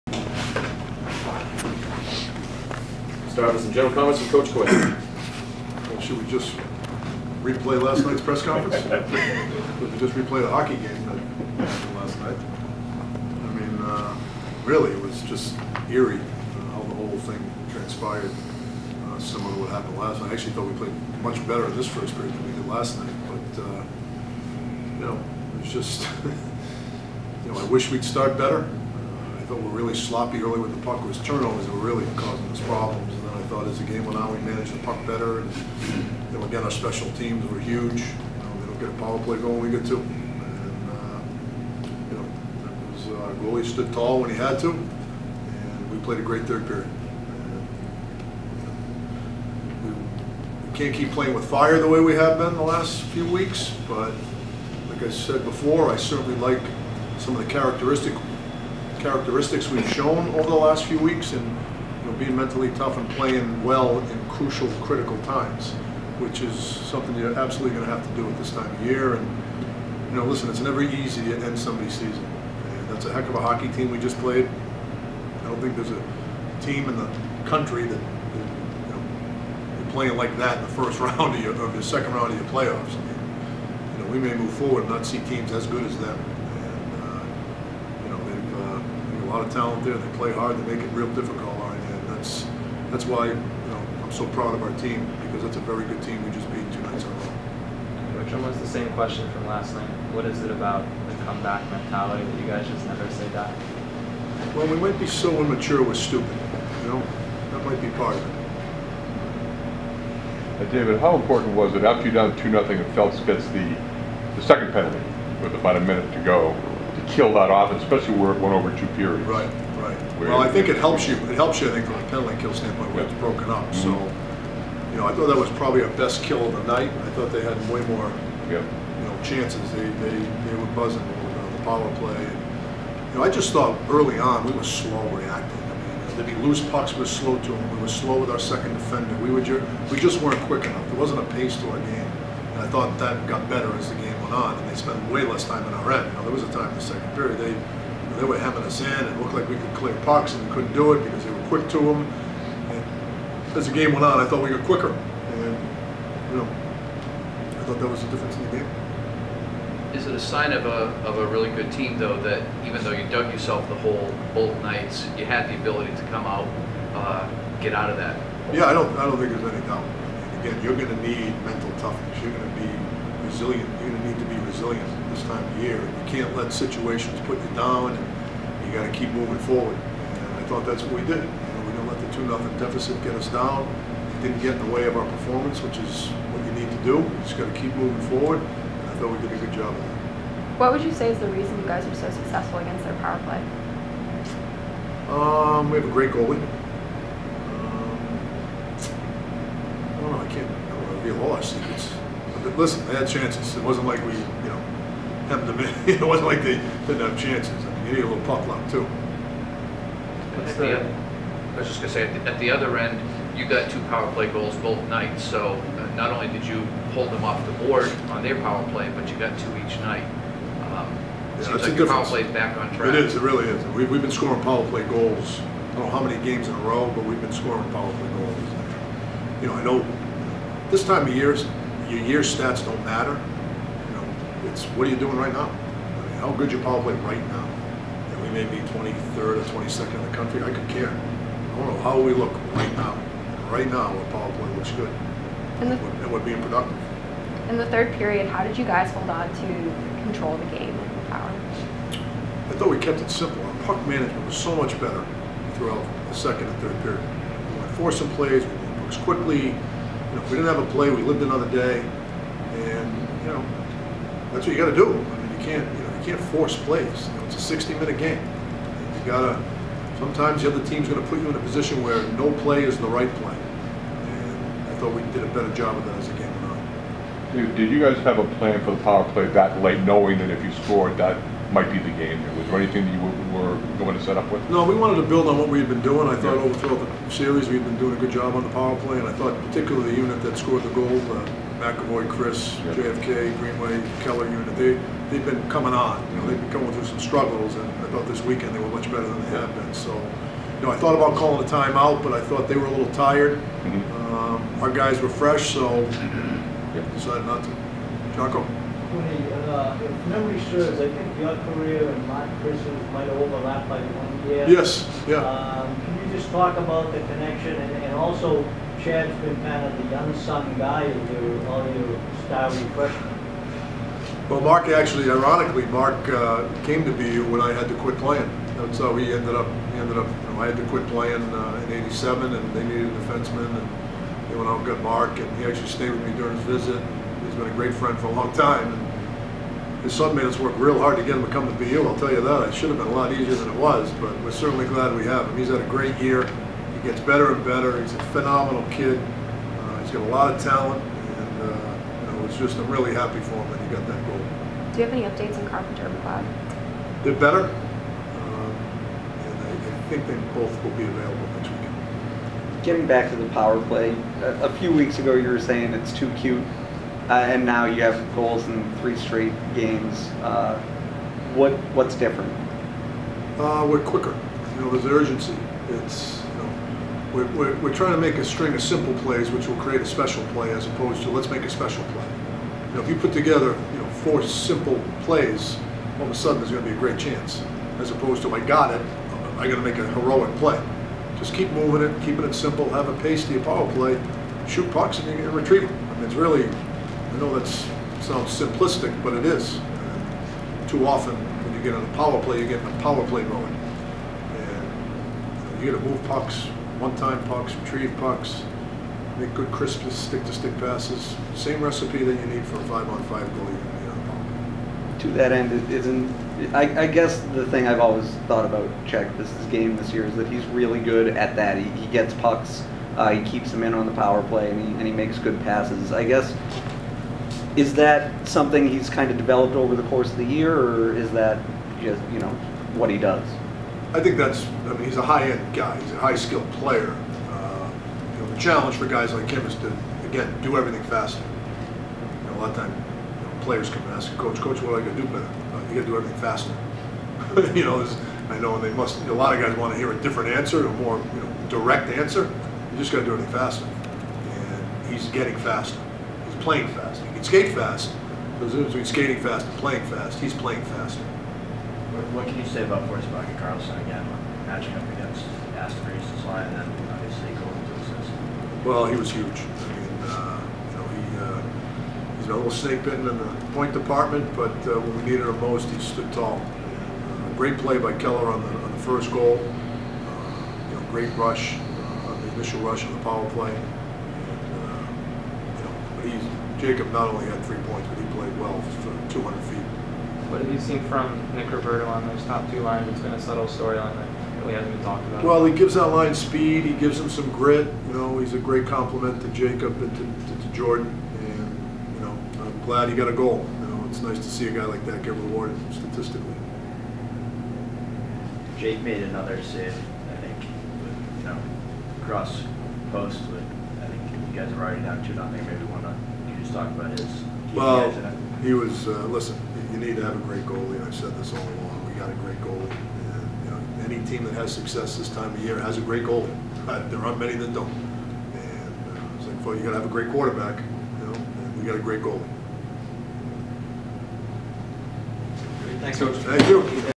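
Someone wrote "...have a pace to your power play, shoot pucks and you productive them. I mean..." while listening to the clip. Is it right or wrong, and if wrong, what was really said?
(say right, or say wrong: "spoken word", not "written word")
wrong: "retrieve", not "productive".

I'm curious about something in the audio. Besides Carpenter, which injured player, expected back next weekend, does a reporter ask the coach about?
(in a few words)
MacLeod.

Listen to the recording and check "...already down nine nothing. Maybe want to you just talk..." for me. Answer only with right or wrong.
wrong.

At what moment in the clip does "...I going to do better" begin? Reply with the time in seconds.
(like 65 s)
444 s.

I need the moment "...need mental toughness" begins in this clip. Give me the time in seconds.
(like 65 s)
171 s.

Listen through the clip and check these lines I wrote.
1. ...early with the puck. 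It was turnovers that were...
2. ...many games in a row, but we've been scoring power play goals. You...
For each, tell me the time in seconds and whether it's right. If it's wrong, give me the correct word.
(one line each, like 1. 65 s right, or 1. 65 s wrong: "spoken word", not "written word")
1. 30 s right
2. 226 s right.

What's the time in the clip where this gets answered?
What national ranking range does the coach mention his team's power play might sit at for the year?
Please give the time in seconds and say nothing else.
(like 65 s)
238 s.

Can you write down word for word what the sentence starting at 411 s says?
Same recipe that you need for a five-on-five goalie.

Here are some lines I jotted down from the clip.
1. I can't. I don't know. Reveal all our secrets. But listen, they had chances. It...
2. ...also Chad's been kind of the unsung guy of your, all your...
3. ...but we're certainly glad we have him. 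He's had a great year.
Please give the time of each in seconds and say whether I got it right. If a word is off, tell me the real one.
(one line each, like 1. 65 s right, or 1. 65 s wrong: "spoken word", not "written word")
1. 200 s right
2. 318 s right
3. 343 s right.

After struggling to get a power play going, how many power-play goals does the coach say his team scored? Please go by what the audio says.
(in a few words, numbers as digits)
2.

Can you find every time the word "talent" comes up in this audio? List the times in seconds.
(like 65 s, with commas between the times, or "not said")
89 s, 350 s.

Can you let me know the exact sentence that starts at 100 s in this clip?
What is it about the comeback mentality that you guys just never say die?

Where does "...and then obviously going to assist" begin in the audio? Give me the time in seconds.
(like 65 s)
466 s.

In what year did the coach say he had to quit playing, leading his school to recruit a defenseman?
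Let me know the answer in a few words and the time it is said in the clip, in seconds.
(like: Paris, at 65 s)
1987, at 331 s.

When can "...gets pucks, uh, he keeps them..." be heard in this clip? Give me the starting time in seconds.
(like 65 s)
421 s.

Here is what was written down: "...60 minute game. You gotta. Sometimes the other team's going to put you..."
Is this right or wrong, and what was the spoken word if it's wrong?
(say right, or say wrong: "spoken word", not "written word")
right.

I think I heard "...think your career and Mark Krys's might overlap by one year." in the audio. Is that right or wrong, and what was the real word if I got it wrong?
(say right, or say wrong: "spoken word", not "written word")
right.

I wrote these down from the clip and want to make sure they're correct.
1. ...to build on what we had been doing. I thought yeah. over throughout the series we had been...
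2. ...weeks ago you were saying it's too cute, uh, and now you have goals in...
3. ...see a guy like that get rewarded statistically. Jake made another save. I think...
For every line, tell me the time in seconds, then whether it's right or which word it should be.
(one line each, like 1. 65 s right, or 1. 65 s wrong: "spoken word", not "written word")
1. 284 s right
2. 364 s right
3. 504 s right.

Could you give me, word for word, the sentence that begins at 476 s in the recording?
Uh, great play by Keller on the, on the first goal.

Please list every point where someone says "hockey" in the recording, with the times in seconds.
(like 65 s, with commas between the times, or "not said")
10 s, 73 s.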